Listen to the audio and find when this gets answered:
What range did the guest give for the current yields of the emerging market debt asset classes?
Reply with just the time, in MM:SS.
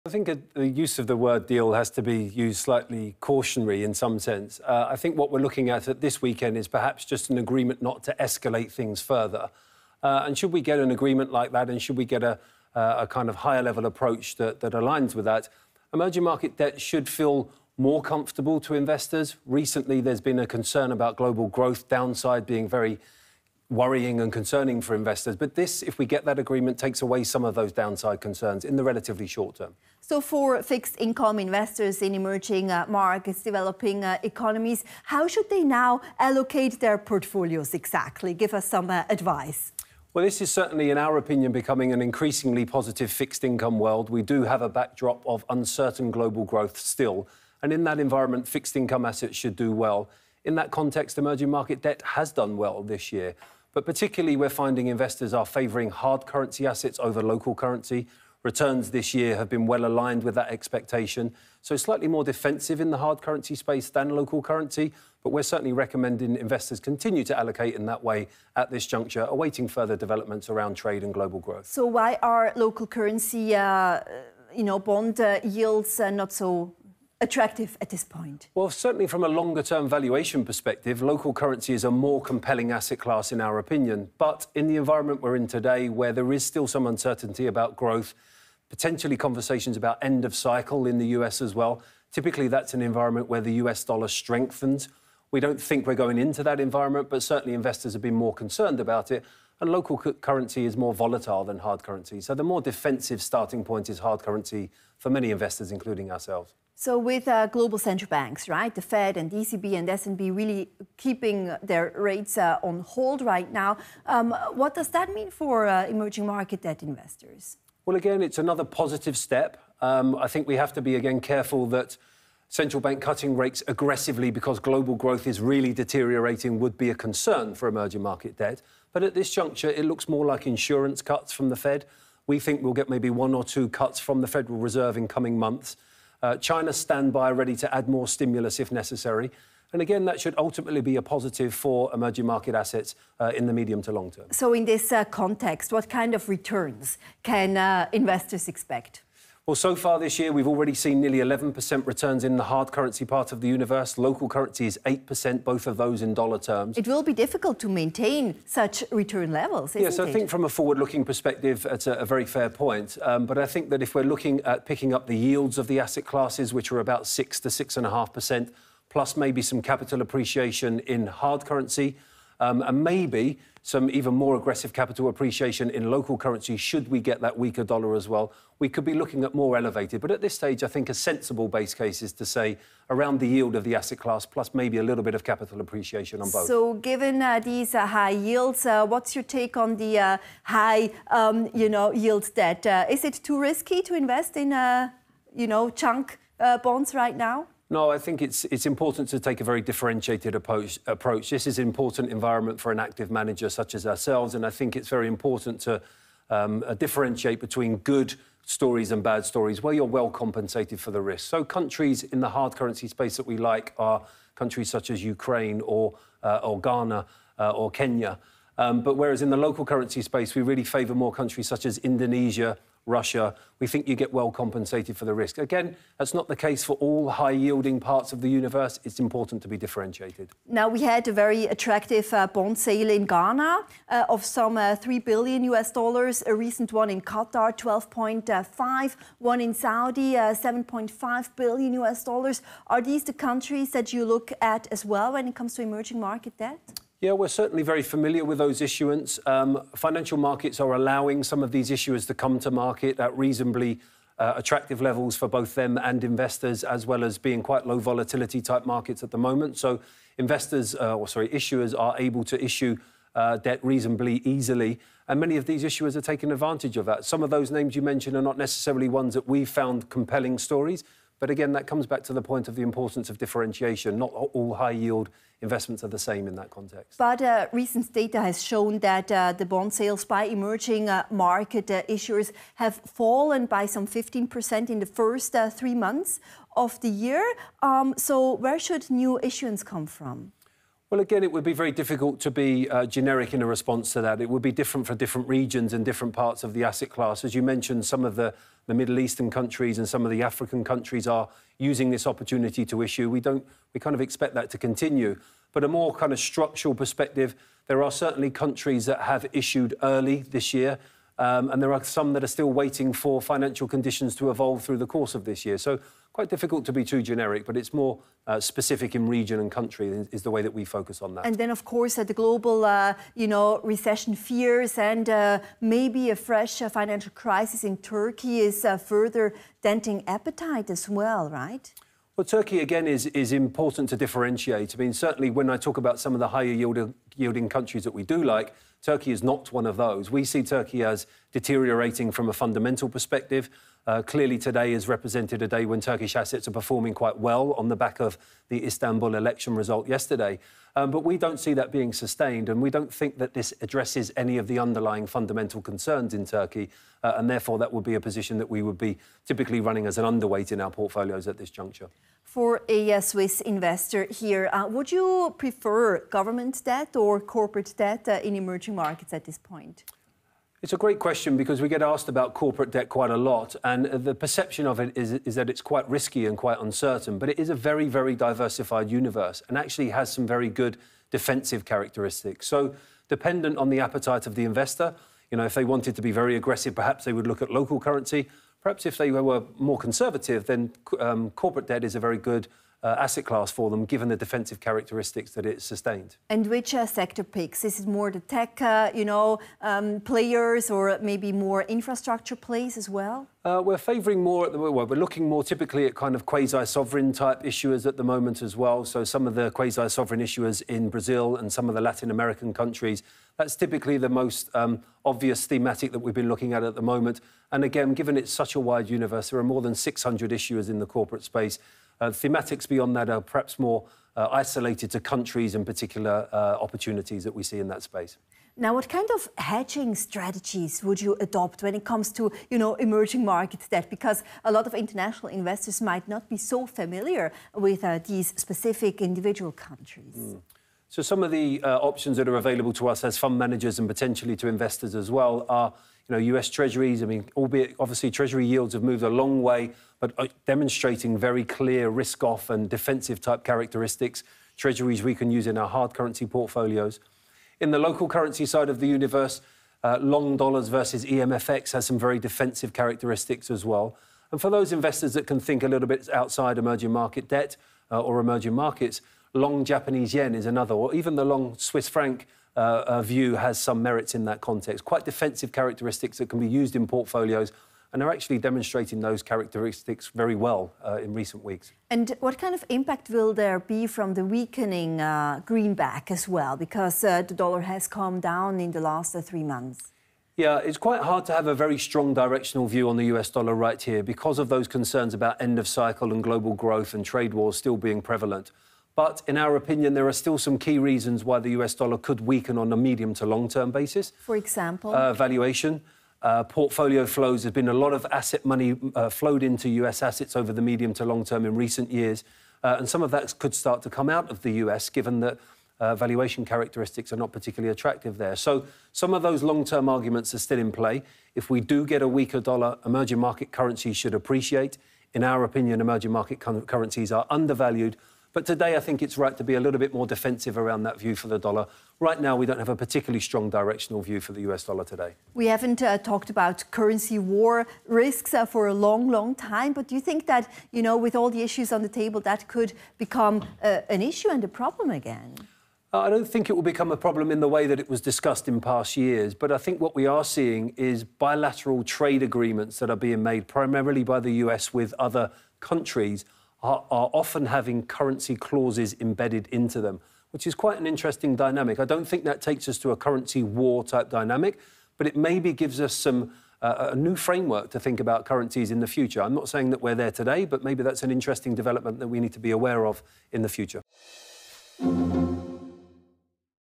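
02:47.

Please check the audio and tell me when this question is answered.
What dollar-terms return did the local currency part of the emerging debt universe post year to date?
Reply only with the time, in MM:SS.
02:33.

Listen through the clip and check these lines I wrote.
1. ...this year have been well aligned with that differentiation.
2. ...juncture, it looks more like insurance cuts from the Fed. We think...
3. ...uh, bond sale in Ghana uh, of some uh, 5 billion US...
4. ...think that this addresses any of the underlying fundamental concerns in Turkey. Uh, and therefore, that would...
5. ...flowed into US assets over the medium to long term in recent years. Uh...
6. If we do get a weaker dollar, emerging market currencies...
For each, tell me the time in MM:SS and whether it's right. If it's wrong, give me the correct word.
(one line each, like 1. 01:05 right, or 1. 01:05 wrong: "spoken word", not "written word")
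1. 00:58 wrong: "expectation", not "differentiation"
2. 02:09 right
3. 03:52 wrong: "3", not "5"
4. 05:52 right
5. 08:29 right
6. 08:41 right.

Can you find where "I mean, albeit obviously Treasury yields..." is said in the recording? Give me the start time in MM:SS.
07:27.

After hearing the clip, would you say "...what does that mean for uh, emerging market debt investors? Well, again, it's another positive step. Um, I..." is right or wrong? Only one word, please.
right.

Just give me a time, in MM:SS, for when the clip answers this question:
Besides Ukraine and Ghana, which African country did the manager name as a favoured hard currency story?
03:37.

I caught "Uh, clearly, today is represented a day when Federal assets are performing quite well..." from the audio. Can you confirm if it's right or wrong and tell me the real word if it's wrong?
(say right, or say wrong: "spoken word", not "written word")
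wrong: "Turkish", not "Federal".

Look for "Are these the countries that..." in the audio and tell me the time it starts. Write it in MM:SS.
04:02.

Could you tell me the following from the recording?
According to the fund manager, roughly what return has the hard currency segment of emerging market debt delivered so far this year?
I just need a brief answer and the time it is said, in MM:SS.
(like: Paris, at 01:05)
nearly 11%, at 02:31.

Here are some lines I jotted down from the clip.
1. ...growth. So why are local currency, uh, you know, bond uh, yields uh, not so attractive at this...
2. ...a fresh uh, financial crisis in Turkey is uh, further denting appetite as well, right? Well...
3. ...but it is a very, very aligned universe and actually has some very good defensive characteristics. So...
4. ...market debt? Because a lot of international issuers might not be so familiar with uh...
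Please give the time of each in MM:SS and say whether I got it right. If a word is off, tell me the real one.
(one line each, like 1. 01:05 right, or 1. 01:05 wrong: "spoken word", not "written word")
1. 01:11 right
2. 05:26 right
3. 06:17 wrong: "diversified", not "aligned"
4. 07:13 wrong: "investors", not "issuers".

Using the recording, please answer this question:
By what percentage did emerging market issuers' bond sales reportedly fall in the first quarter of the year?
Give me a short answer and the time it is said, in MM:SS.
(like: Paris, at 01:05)
15%, at 04:43.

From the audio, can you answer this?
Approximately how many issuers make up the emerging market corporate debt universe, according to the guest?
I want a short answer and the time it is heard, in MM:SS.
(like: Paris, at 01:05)
more than 600, at 06:59.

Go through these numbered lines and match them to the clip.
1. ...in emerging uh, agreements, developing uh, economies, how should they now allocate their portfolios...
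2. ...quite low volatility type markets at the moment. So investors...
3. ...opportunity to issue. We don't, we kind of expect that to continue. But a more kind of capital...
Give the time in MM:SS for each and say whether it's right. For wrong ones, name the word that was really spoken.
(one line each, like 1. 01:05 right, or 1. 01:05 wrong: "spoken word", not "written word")
1. 00:32 wrong: "markets", not "agreements"
2. 04:17 right
3. 05:02 wrong: "structural", not "capital".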